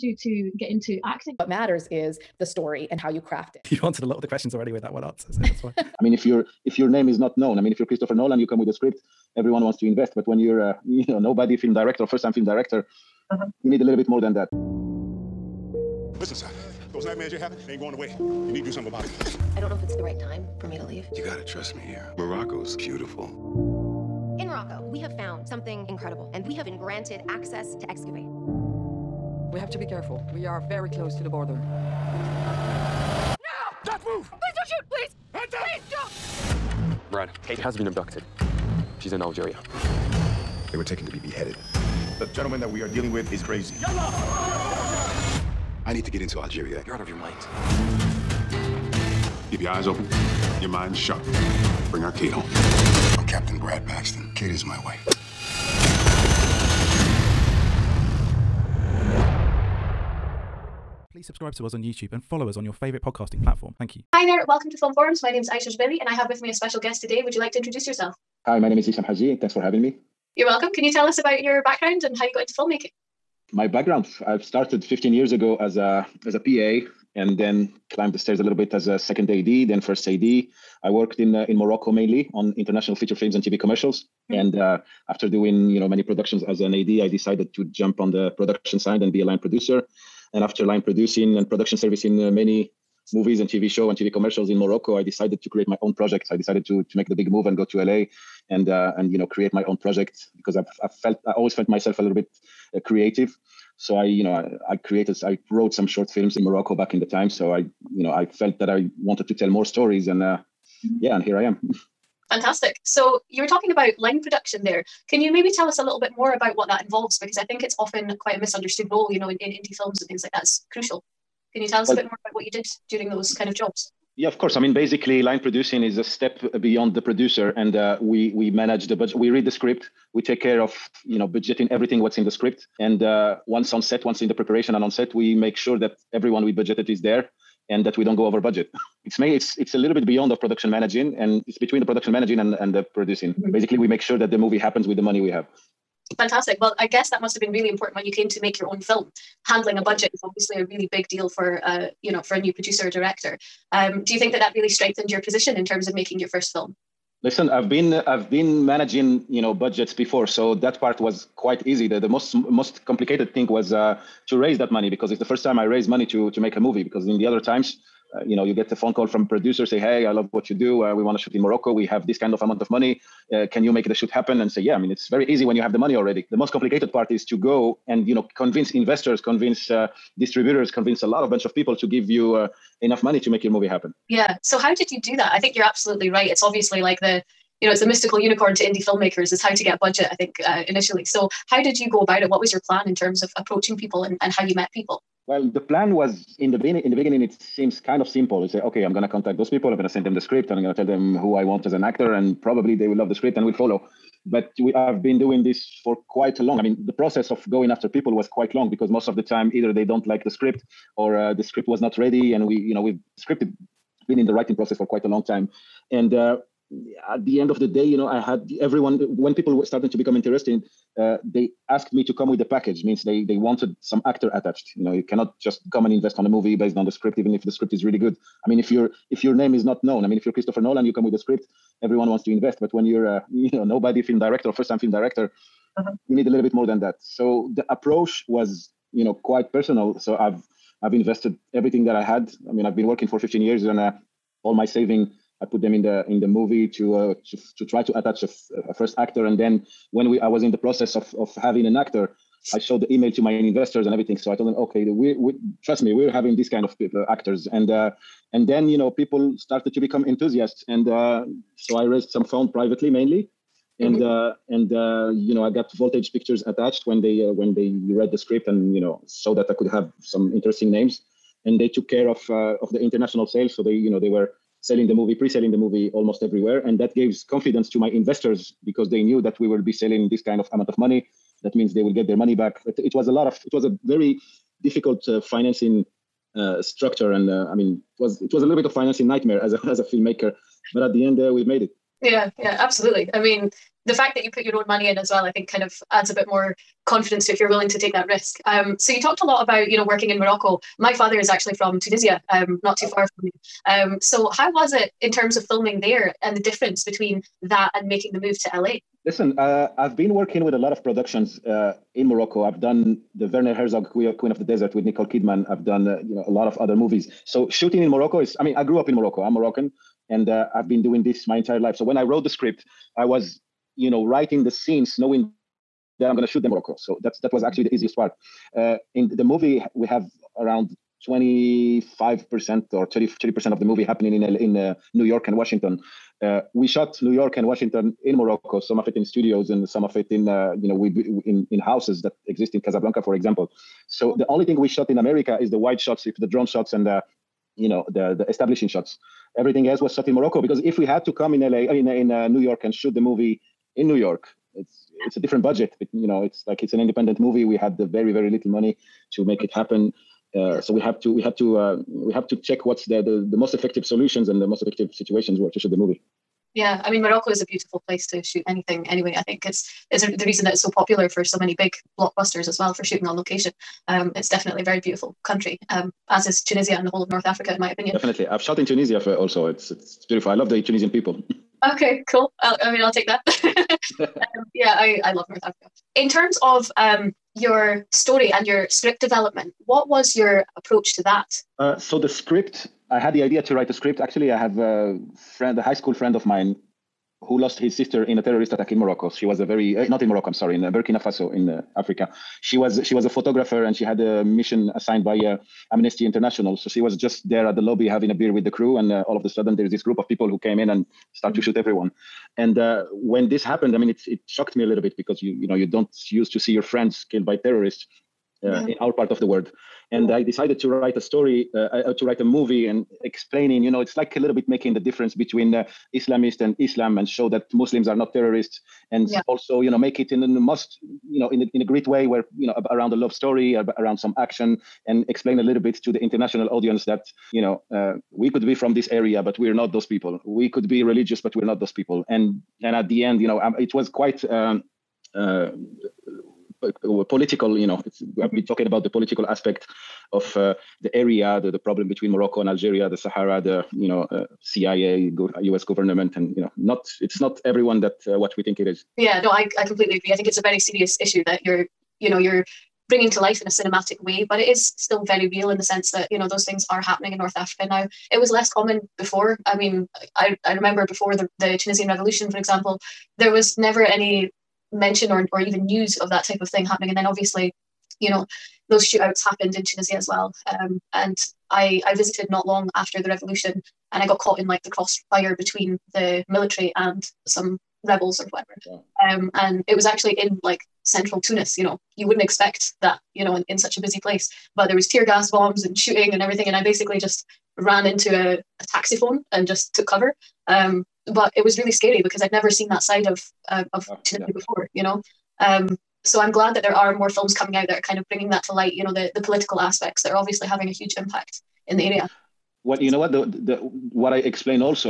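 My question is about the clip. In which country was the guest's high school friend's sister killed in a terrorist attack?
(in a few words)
Burkina Faso.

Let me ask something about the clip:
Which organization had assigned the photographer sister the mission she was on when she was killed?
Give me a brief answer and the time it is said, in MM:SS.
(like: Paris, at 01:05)
Amnesty International, at 06:45.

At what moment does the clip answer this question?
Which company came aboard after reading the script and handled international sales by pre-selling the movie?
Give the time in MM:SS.
04:25.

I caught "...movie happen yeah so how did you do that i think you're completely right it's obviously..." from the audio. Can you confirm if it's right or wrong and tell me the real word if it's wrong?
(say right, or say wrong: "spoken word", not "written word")
wrong: "absolutely", not "completely".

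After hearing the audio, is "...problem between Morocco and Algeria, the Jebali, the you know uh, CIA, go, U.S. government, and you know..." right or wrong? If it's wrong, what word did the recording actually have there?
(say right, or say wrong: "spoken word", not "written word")
wrong: "Sahara", not "Jebali".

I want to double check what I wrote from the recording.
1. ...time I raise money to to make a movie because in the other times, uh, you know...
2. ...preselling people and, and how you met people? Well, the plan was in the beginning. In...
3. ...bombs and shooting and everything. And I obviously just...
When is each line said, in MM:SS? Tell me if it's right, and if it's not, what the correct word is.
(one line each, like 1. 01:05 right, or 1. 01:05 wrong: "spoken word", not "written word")
1. 02:45 right
2. 03:13 wrong: "approaching", not "preselling"
3. 08:15 wrong: "basically", not "obviously".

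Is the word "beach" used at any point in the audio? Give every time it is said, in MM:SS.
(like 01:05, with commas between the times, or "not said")
not said.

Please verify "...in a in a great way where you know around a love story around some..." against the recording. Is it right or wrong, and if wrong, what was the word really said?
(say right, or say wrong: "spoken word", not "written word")
right.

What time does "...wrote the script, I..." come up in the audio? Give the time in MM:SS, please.
05:22.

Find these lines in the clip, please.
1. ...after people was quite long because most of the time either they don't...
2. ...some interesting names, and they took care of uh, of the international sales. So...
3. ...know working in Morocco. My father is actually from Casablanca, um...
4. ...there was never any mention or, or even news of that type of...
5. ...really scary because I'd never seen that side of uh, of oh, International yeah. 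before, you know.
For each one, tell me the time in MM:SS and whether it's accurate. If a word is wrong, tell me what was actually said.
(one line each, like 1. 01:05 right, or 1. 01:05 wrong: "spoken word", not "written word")
1. 03:27 right
2. 04:30 right
3. 04:59 wrong: "Tunisia", not "Casablanca"
4. 07:53 right
5. 08:21 wrong: "Tunisia", not "International".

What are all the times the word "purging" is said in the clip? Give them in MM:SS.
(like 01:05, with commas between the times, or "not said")
not said.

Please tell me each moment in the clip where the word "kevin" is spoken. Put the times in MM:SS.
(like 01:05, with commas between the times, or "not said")
not said.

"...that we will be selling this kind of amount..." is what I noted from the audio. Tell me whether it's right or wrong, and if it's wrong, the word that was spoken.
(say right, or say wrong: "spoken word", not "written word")
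right.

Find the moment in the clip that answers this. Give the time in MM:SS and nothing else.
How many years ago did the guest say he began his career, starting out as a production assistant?
01:14.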